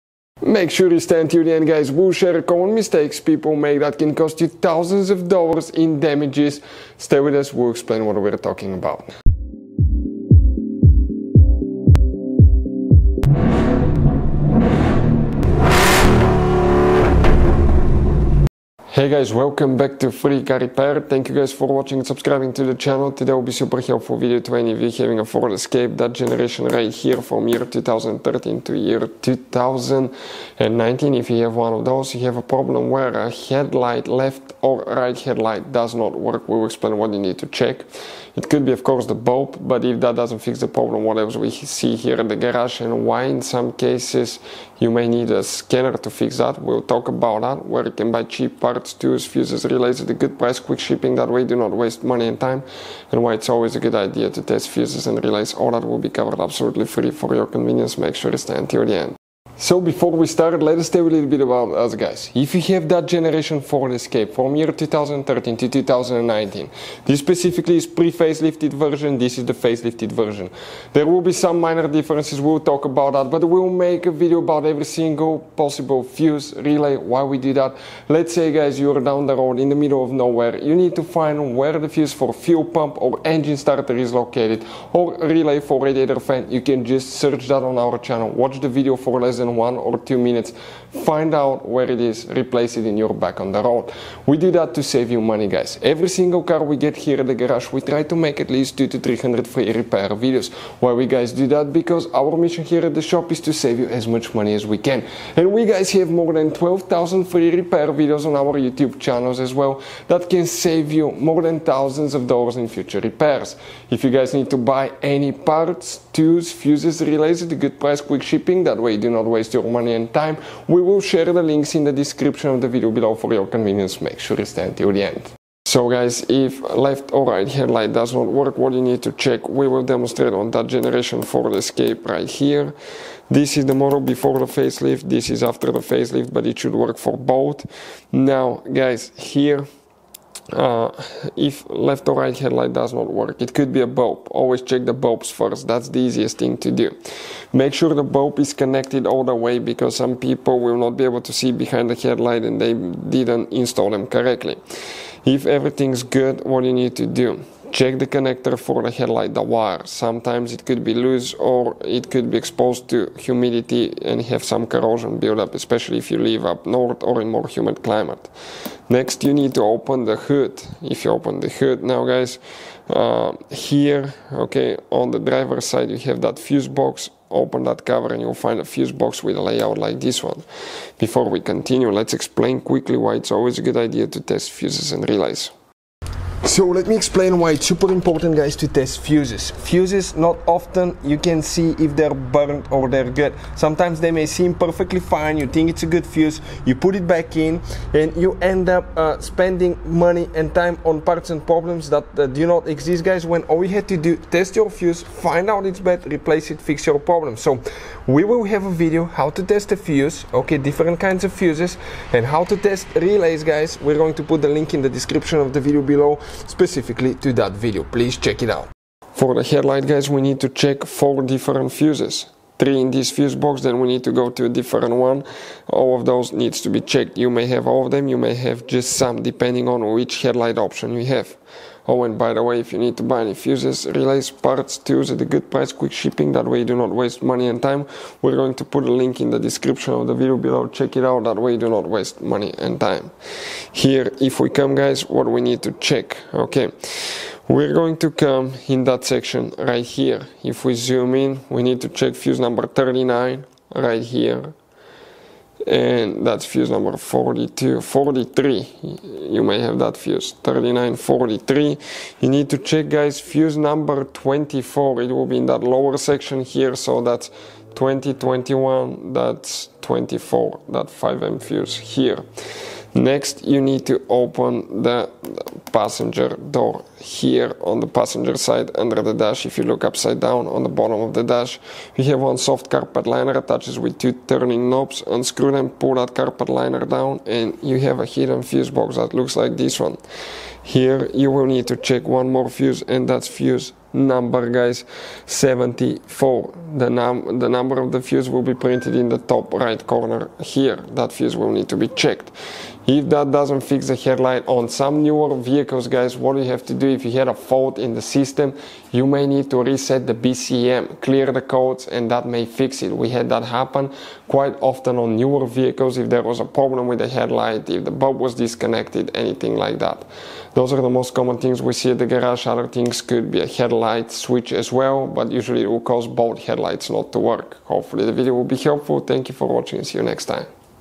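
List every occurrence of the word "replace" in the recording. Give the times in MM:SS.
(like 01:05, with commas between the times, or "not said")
01:32, 03:26.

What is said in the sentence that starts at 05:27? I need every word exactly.
Hopefully the video will be helpful.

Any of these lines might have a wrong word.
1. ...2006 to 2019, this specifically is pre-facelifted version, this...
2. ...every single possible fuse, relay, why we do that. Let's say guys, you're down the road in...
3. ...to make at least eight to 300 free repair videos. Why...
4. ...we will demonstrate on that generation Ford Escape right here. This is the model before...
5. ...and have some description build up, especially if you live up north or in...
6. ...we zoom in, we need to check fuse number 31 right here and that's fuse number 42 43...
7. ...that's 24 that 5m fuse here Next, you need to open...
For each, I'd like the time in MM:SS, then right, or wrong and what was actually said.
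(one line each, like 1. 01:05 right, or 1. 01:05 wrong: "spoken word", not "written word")
1. 01:04 wrong: "2013", not "2006"
2. 01:14 right
3. 01:38 wrong: "two", not "eight"
4. 02:09 right
5. 02:44 wrong: "corrosion", not "description"
6. 04:10 wrong: "39", not "31"
7. 04:29 right.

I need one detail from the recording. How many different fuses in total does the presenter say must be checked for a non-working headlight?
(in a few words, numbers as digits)
4.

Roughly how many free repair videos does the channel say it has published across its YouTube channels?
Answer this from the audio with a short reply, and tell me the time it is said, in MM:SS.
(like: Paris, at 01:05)
12,000, at 01:46.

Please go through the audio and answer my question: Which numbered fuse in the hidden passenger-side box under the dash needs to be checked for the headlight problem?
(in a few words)
74.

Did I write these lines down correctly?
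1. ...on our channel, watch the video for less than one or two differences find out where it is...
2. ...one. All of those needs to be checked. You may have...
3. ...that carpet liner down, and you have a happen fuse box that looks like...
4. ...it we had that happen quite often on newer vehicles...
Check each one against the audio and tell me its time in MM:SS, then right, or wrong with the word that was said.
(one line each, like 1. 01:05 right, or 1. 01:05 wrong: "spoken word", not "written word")
1. 01:27 wrong: "minutes", not "differences"
2. 03:44 right
3. 04:45 wrong: "hidden", not "happen"
4. 05:12 right.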